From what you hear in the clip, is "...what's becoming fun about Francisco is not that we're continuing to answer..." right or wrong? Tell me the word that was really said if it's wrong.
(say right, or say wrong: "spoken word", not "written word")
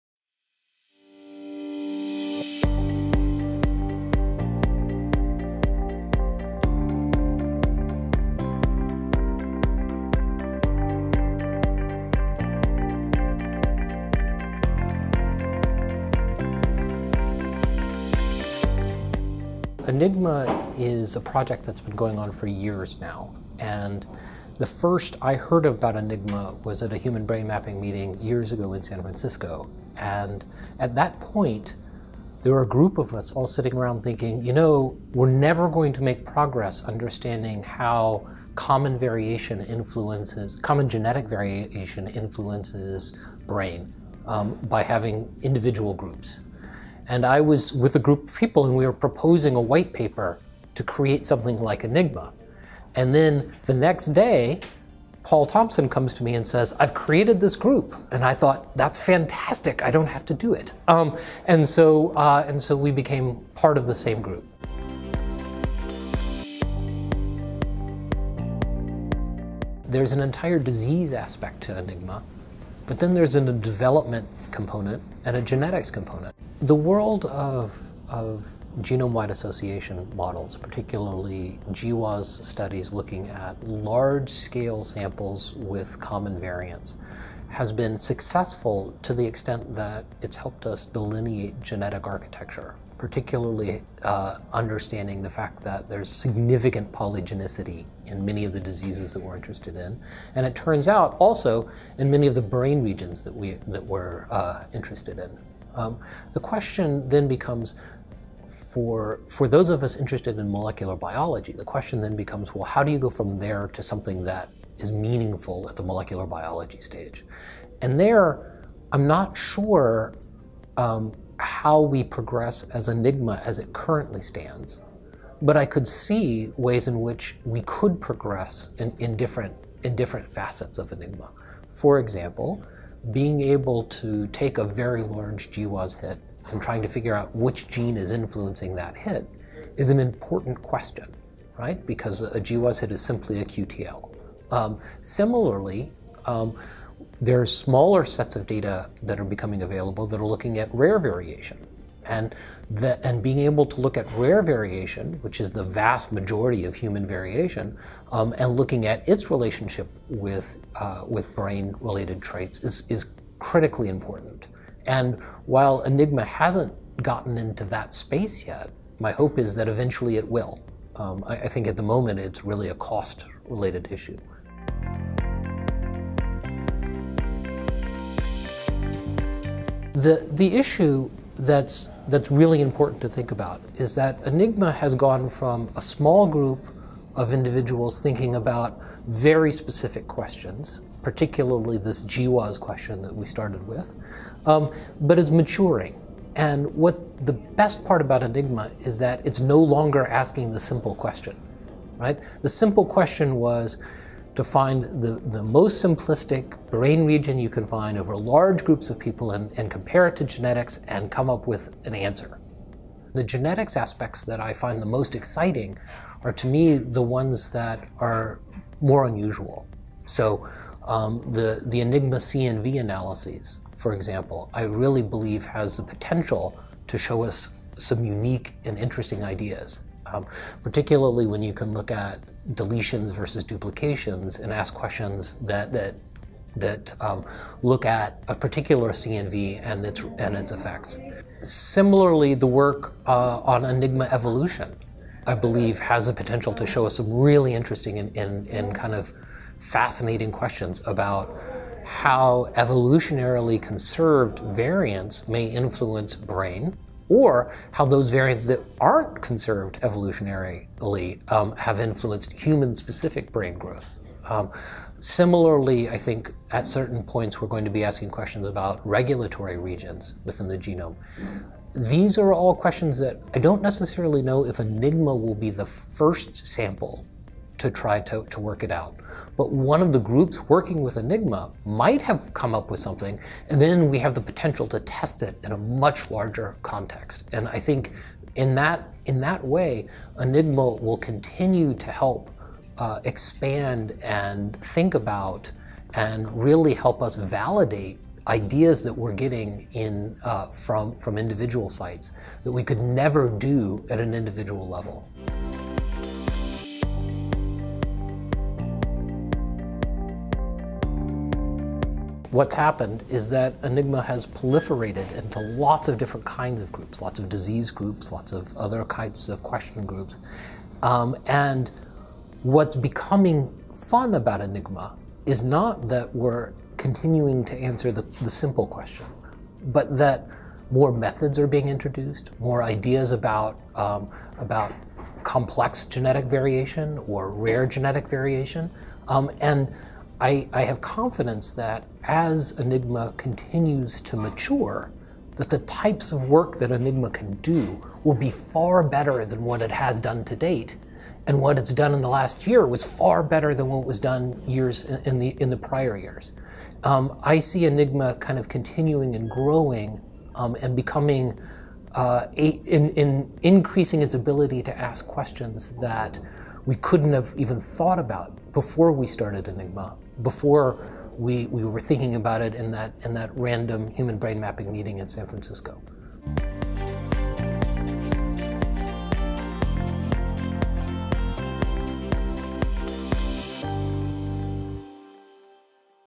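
wrong: "Enigma", not "Francisco".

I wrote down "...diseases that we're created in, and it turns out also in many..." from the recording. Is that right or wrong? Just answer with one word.
wrong.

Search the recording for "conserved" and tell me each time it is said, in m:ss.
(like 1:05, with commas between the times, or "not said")
4:13, 4:19.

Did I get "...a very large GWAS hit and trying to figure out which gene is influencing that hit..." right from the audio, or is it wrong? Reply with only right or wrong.
right.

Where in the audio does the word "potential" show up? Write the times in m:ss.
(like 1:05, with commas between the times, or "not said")
3:45, 4:06, 4:44.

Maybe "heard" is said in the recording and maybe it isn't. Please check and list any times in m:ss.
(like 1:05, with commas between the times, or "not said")
0:25.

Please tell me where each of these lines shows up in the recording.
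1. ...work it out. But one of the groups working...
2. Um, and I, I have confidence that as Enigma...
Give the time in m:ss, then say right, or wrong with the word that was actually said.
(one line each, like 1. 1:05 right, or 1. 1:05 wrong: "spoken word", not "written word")
1. 4:38 right
2. 5:39 right.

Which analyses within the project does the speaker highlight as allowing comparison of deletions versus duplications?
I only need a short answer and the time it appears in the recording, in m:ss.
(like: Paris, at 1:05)
CNV analyses, at 3:42.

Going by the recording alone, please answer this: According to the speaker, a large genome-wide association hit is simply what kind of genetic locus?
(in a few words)
QTL.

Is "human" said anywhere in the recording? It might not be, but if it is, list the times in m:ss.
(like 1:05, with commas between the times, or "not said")
0:26, 2:36, 4:22, 6:13.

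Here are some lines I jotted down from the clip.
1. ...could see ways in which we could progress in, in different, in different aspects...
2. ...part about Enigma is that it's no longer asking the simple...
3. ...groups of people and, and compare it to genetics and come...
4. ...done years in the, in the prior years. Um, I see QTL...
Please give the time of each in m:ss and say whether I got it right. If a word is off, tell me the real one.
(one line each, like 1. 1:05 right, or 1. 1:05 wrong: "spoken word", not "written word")
1. 2:05 wrong: "facets", not "aspects"
2. 3:17 right
3. 3:28 right
4. 5:53 wrong: "Enigma", not "QTL".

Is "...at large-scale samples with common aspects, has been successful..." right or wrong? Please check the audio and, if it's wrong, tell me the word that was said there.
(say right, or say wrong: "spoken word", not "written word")
wrong: "variants", not "aspects".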